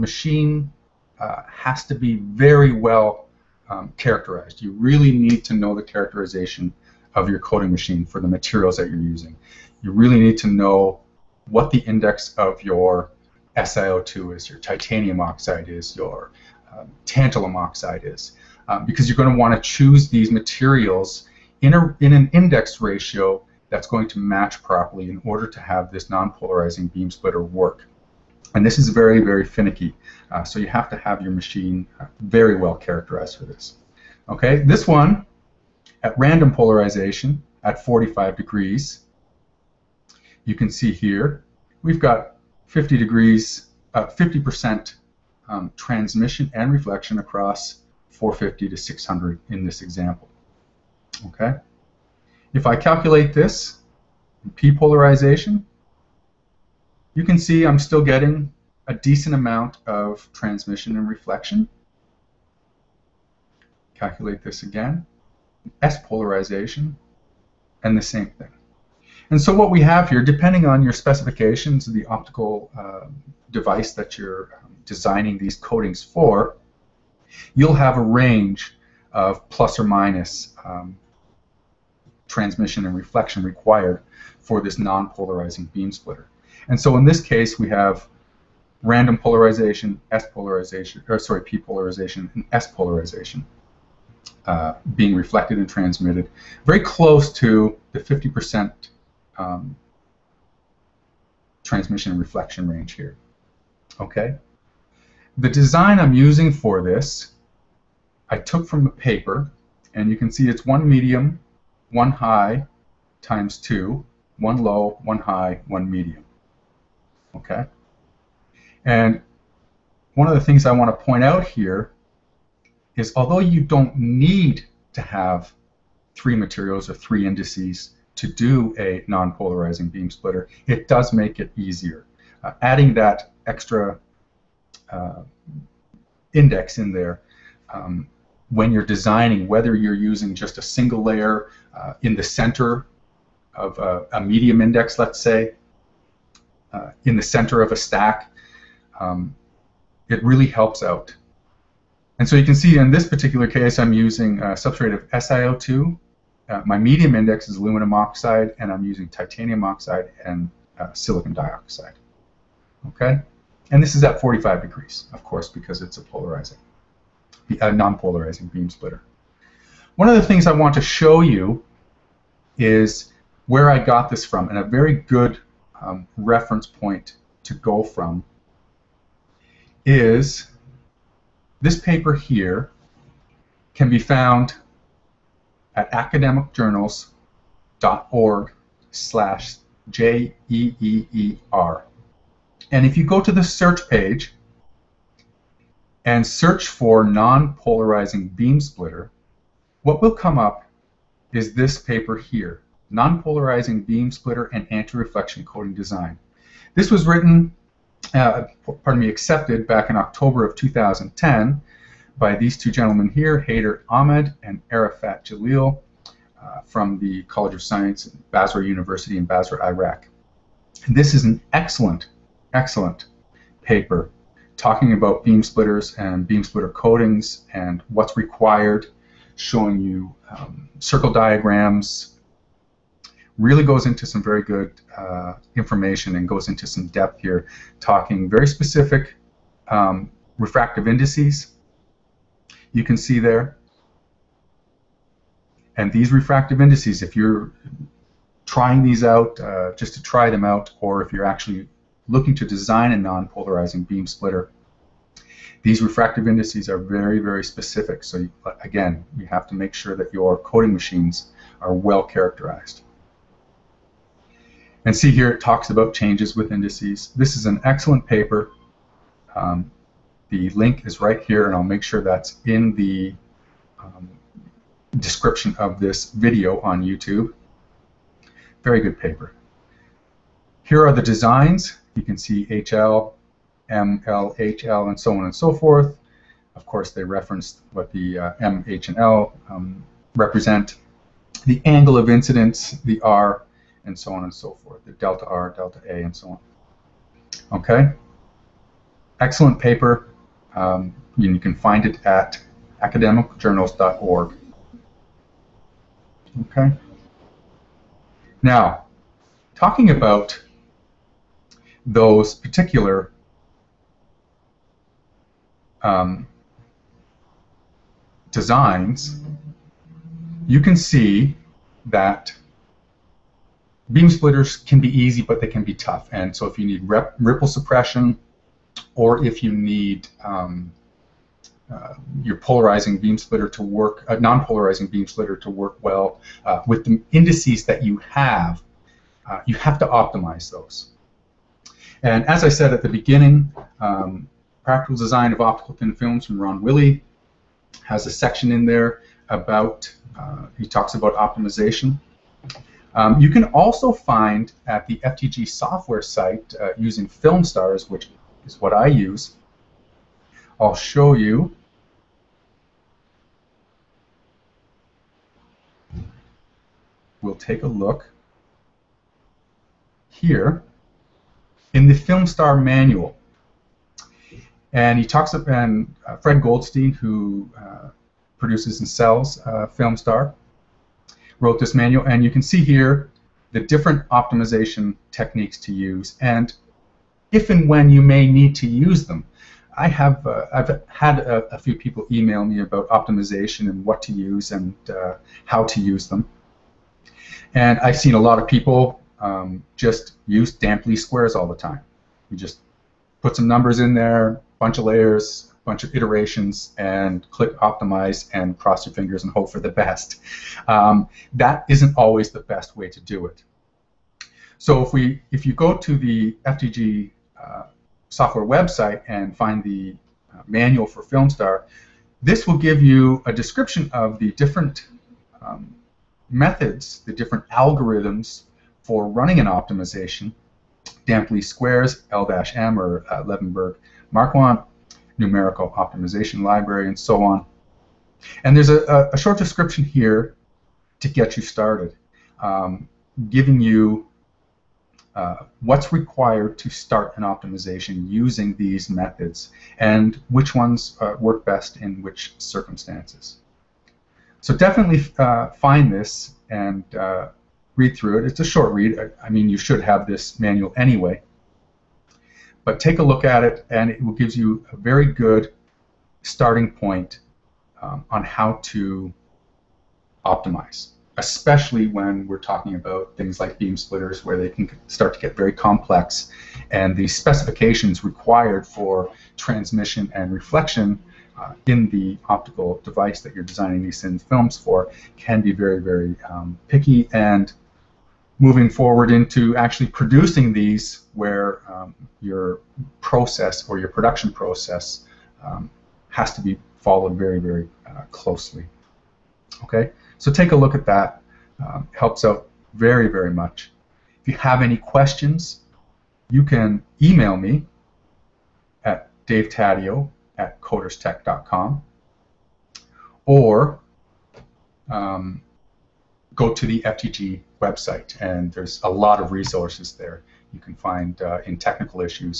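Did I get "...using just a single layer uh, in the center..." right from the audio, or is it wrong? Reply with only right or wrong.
right.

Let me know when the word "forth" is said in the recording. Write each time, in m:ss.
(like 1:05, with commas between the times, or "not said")
4:45, 4:54.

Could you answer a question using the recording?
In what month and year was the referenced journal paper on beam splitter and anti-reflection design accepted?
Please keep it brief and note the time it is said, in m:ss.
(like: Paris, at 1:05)
October 2010, at 3:29.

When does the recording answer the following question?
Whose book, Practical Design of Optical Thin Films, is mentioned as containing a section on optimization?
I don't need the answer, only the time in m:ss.
5:46.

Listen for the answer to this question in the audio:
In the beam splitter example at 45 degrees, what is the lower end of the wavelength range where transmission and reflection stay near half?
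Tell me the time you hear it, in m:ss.
0:48.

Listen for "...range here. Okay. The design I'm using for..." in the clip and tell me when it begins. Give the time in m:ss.
1:42.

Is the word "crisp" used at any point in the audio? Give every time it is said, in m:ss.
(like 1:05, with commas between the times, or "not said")
not said.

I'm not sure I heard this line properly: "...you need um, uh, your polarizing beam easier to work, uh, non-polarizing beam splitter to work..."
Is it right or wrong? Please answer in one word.
wrong.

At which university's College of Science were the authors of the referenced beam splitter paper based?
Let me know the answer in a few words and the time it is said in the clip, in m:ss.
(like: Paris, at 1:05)
Basra University, at 3:38.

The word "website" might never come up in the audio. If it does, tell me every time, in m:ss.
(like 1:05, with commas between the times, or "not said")
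6:58, 8:37.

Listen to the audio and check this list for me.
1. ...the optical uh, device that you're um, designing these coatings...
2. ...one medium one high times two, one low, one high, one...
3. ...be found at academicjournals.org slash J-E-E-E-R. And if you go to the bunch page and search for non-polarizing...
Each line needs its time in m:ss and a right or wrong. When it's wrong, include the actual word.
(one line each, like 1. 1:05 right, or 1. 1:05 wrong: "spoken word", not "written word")
1. 1:11 right
2. 1:50 right
3. 3:03 wrong: "search", not "bunch".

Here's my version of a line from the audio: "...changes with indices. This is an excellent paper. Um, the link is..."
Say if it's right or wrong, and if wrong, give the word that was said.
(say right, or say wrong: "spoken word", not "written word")
right.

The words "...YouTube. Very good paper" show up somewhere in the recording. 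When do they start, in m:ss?
4:36.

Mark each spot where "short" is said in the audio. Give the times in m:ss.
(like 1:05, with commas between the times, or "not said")
7:19, 7:38.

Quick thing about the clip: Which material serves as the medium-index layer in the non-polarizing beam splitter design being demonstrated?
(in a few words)
aluminum oxide.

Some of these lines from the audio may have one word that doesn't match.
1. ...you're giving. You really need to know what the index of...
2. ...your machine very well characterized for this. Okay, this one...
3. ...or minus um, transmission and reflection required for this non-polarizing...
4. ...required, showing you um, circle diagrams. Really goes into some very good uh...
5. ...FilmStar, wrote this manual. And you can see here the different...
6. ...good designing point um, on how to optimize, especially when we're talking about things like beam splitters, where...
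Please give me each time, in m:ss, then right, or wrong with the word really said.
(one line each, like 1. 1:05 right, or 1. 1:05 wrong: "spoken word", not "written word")
1. 0:08 wrong: "using", not "giving"
2. 0:31 right
3. 1:19 right
4. 3:48 right
5. 6:19 right
6. 7:45 wrong: "starting", not "designing".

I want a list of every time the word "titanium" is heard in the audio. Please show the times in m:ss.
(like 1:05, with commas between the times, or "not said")
0:14, 2:39.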